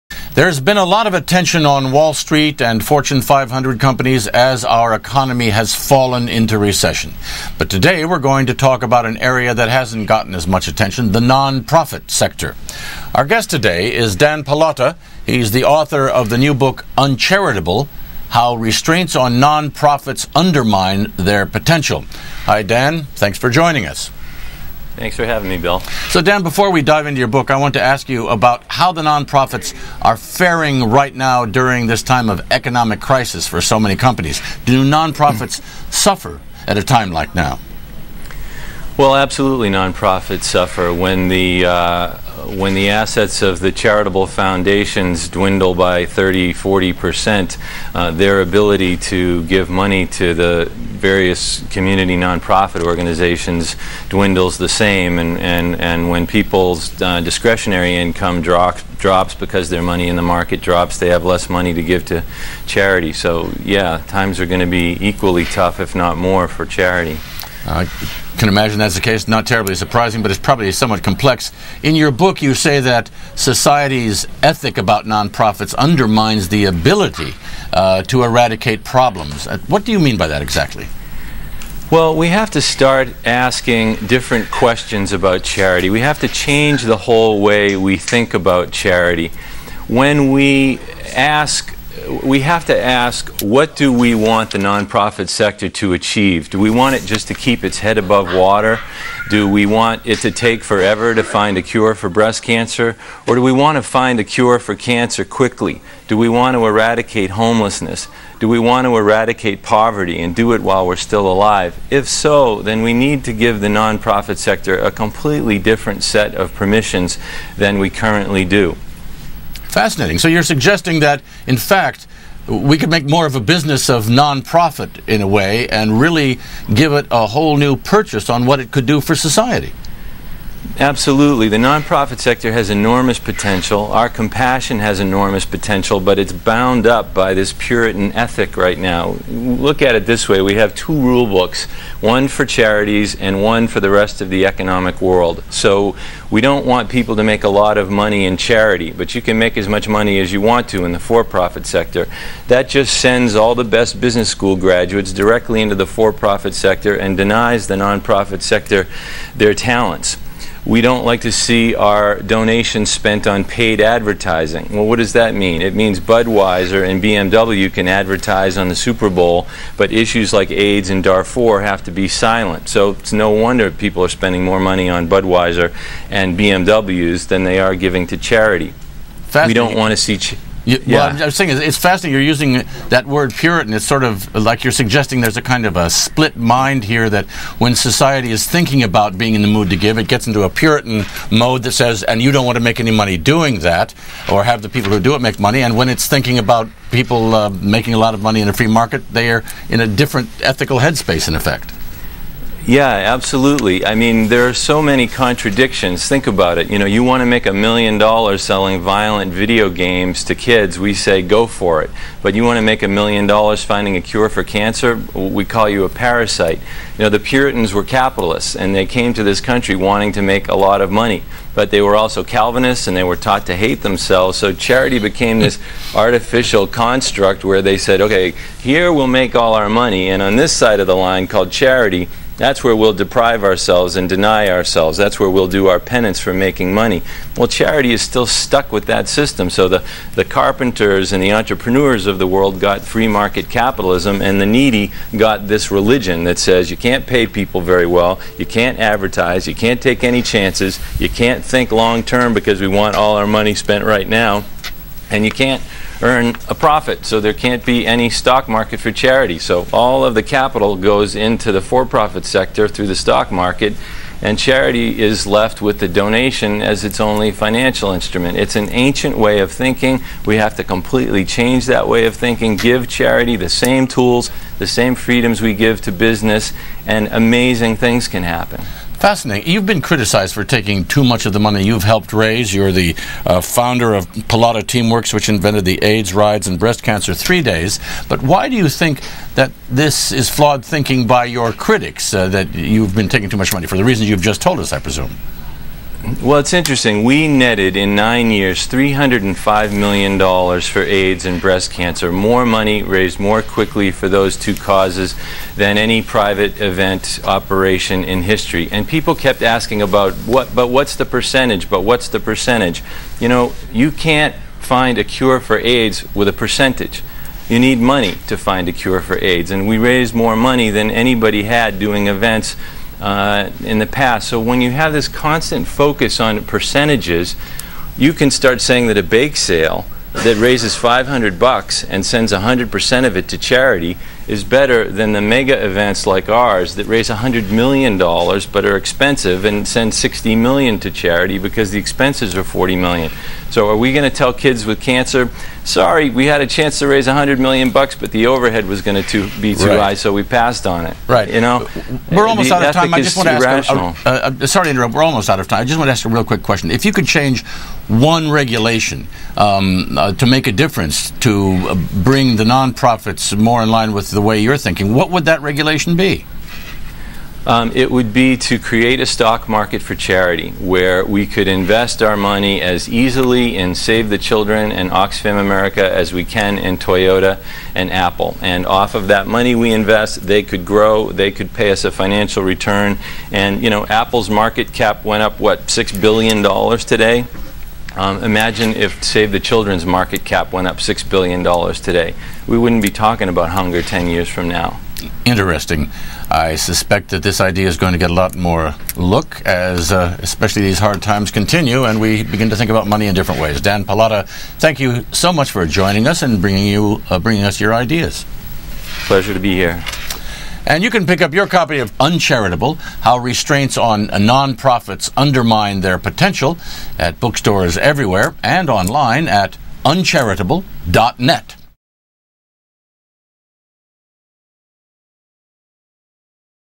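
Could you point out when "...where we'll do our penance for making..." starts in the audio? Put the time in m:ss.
3:55.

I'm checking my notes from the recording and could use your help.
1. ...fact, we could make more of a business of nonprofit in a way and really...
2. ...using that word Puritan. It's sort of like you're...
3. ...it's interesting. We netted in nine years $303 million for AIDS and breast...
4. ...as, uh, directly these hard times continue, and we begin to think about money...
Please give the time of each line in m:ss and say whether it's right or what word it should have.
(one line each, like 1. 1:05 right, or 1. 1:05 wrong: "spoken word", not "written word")
1. 2:01 right
2. 3:02 right
3. 4:56 wrong: "305", not "303"
4. 6:39 wrong: "especially", not "directly".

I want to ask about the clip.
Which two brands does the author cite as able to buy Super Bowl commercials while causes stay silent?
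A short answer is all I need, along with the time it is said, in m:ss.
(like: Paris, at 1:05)
Budweiser and BMW, at 2:45.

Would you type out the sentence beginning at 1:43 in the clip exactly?
Or do we want to find a cure for cancer quickly?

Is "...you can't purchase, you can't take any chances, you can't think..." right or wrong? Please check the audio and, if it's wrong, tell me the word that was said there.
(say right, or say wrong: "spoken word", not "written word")
wrong: "advertise", not "purchase".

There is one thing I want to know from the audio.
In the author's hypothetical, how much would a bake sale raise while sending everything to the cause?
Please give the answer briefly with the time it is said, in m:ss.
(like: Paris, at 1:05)
500 bucks, at 5:30.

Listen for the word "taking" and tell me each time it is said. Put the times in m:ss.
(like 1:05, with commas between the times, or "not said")
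4:40, 4:53.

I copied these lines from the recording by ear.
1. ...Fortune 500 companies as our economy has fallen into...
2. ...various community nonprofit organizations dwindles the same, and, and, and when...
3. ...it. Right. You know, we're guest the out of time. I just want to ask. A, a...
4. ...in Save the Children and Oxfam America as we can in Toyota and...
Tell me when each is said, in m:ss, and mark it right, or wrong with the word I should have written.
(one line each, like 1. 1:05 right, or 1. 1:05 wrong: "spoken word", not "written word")
1. 0:02 right
2. 0:51 right
3. 5:50 wrong: "almost", not "guest"
4. 6:13 right.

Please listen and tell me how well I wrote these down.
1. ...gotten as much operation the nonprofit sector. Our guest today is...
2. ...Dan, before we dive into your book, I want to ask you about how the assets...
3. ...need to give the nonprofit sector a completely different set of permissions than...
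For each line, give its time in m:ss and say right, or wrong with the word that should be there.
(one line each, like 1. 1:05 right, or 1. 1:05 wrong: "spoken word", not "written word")
1. 0:10 wrong: "attention", not "operation"
2. 0:26 wrong: "nonprofits", not "assets"
3. 1:52 right.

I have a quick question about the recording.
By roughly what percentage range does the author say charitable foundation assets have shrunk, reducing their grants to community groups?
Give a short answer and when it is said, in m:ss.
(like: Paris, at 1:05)
30 to 40 percent, at 0:46.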